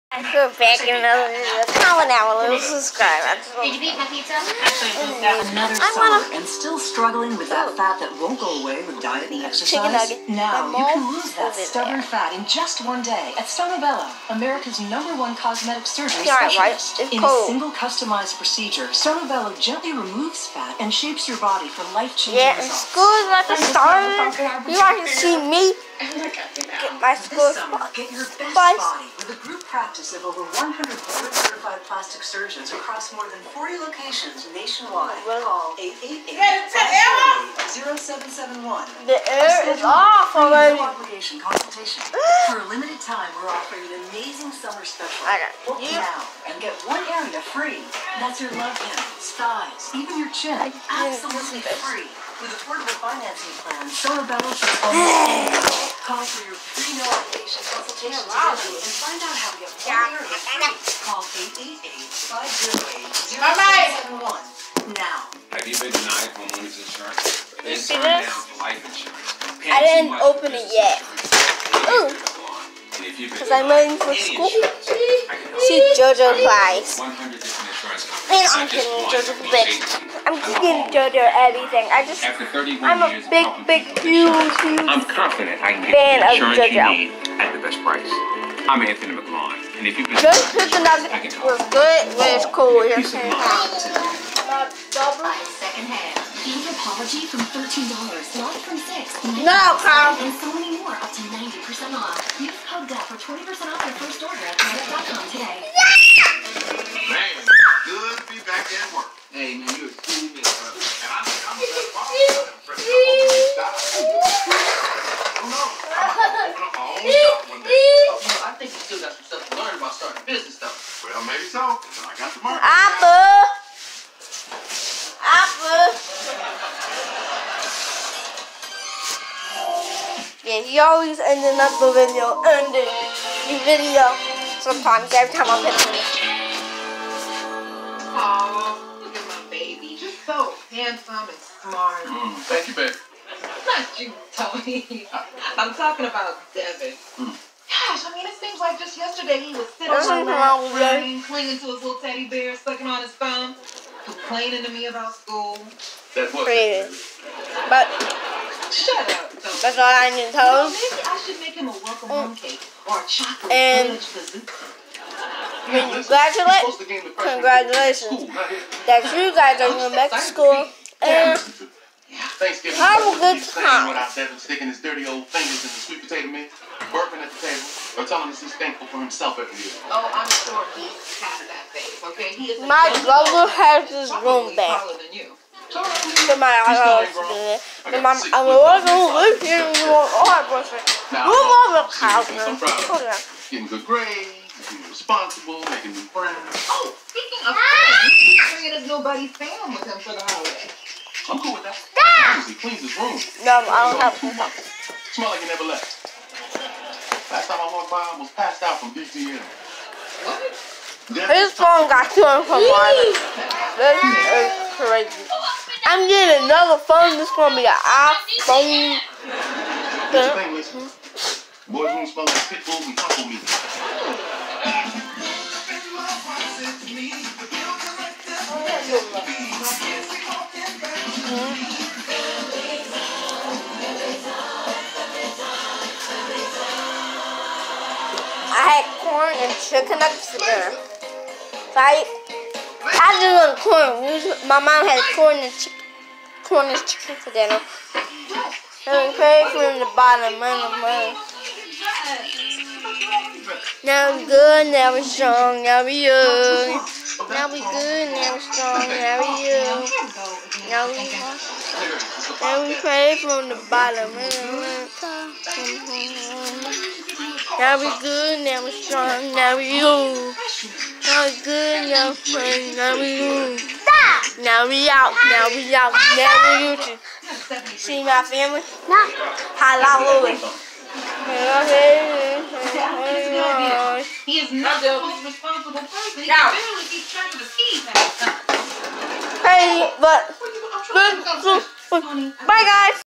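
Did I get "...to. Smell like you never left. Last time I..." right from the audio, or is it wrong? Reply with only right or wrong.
right.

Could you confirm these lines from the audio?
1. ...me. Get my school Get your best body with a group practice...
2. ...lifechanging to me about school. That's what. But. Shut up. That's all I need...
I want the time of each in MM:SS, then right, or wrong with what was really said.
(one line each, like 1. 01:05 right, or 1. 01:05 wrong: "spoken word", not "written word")
1. 00:25 right
2. 02:34 wrong: "complaining", not "lifechanging".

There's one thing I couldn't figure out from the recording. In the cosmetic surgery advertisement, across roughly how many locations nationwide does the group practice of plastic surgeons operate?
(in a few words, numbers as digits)
40.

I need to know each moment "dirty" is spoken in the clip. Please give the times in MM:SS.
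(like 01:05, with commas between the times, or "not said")
02:54.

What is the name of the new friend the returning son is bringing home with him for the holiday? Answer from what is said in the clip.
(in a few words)
Sam.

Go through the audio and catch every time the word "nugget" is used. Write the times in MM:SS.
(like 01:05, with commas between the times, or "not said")
00:09, 01:30.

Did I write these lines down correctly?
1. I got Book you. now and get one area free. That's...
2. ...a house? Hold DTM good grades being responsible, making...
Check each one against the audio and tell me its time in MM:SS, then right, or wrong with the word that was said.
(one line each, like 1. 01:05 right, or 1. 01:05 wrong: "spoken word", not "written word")
1. 00:45 right
2. 03:12 wrong: "Getting", not "DTM".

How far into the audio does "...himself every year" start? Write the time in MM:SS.
02:58.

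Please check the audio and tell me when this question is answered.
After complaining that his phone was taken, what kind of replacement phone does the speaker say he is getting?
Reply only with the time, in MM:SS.
03:37.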